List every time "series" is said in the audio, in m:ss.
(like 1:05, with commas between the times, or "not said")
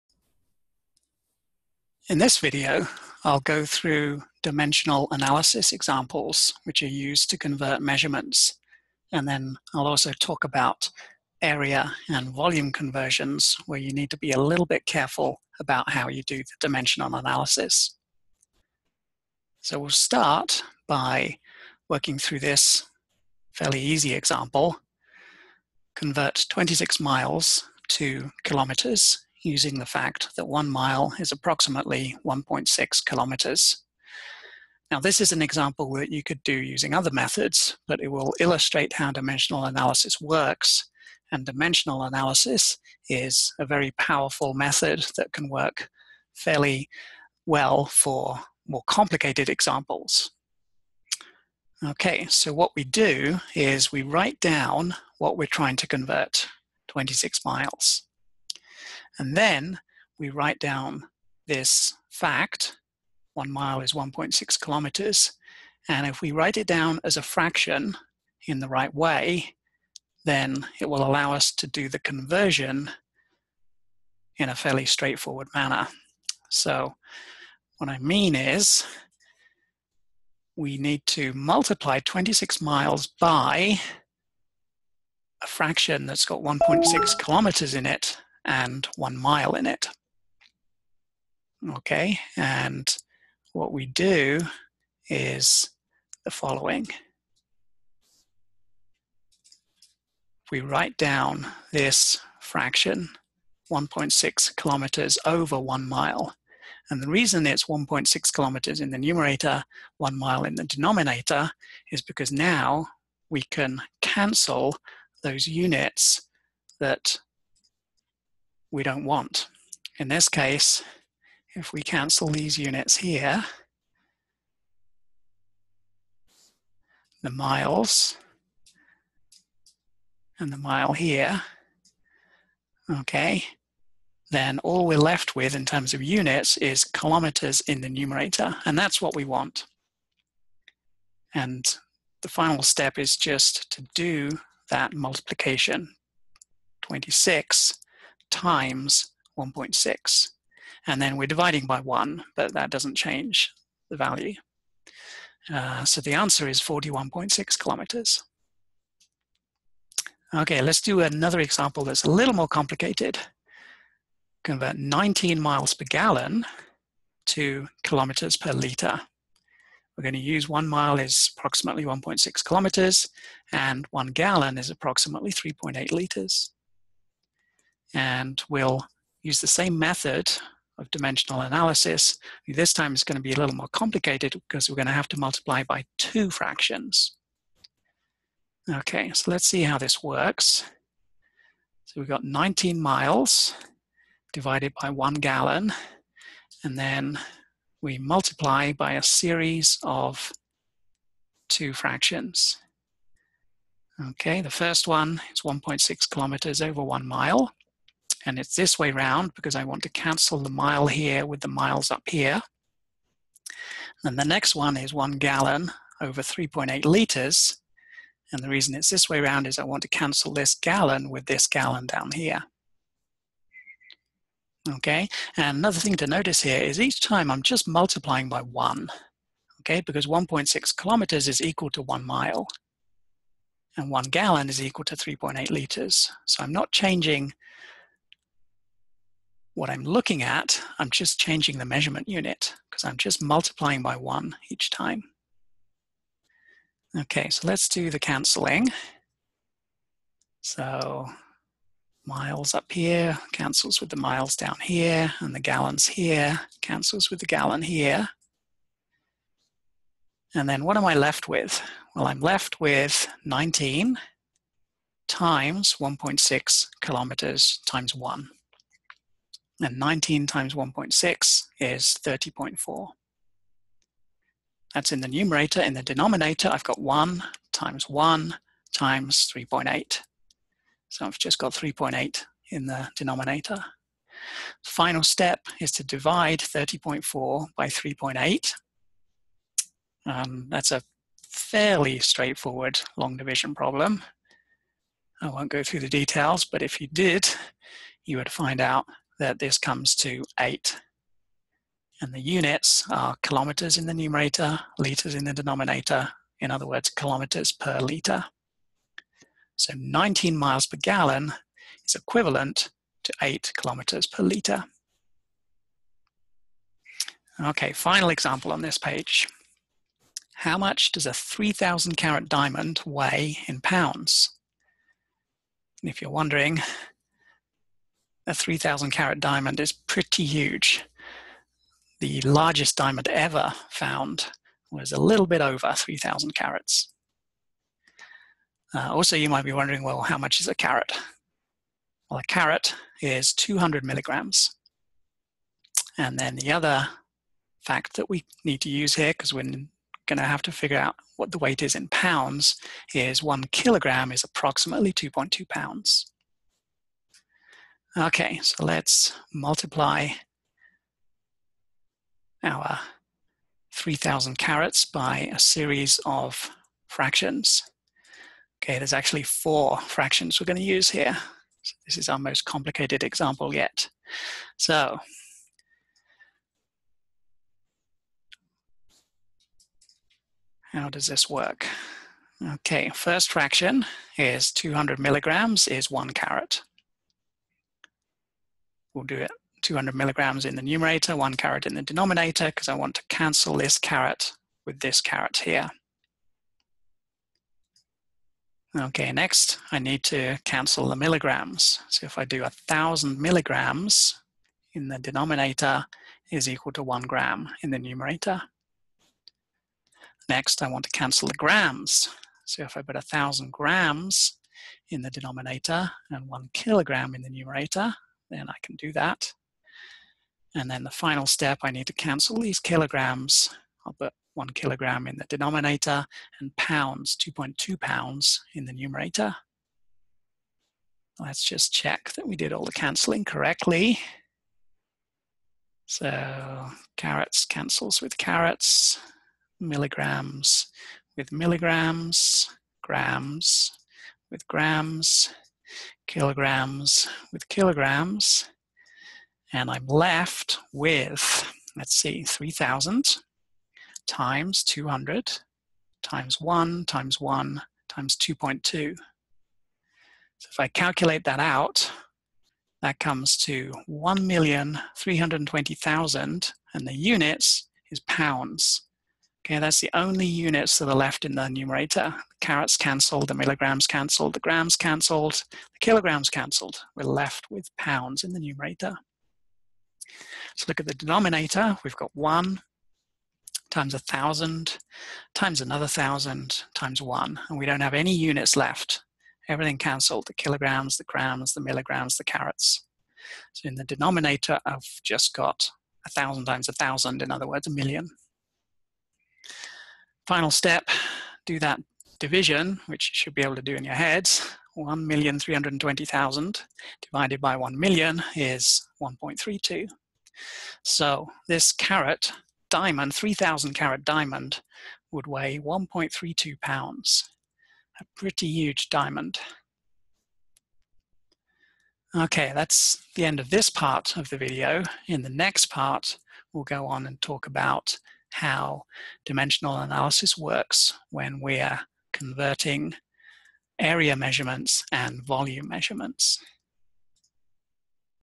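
3:19, 6:05.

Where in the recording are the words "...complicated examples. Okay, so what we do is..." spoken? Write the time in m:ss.
0:48.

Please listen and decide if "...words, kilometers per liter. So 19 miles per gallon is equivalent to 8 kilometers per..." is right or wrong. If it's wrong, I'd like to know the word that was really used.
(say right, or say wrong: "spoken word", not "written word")
right.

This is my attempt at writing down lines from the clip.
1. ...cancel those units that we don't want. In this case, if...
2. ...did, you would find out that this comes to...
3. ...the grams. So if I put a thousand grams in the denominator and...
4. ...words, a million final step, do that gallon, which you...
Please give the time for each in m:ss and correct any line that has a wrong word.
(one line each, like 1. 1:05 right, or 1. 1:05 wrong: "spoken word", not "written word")
1. 1:54 right
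2. 4:56 right
3. 6:51 right
4. 8:17 wrong: "division", not "gallon".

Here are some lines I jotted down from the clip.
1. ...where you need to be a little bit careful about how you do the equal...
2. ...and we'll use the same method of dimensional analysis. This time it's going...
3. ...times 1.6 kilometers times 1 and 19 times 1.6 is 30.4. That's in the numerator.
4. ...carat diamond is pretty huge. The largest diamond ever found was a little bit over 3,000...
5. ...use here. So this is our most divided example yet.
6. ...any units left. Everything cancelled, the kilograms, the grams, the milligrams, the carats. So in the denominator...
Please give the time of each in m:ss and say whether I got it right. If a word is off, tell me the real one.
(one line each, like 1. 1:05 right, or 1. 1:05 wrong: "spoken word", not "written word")
1. 0:13 wrong: "dimensional", not "equal"
2. 2:57 right
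3. 4:25 right
4. 5:28 right
5. 6:10 wrong: "complicated", not "divided"
6. 8:07 right.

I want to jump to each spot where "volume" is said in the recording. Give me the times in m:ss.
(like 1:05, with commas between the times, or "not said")
0:12, 8:55.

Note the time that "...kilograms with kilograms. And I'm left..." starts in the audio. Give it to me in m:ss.
7:26.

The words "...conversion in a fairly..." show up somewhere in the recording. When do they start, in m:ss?
1:11.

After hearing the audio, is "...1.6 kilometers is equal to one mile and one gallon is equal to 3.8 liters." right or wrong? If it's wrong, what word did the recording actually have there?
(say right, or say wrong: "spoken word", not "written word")
right.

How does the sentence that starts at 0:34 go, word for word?
Now, this is an example that you could do using other methods, but it will illustrate how dimensional analysis works.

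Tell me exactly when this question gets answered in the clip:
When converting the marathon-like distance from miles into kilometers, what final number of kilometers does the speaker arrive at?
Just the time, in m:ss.
2:36.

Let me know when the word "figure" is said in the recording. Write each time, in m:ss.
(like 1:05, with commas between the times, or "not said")
5:50.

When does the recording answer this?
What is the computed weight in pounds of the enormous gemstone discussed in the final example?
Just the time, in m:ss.
8:35.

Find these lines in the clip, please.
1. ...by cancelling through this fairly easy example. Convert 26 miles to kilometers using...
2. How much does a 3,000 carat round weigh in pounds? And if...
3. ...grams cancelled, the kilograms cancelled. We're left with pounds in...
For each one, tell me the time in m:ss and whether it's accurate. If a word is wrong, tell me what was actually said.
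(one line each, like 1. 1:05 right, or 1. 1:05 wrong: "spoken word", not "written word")
1. 0:20 wrong: "working", not "cancelling"
2. 5:20 wrong: "diamond", not "round"
3. 7:54 right.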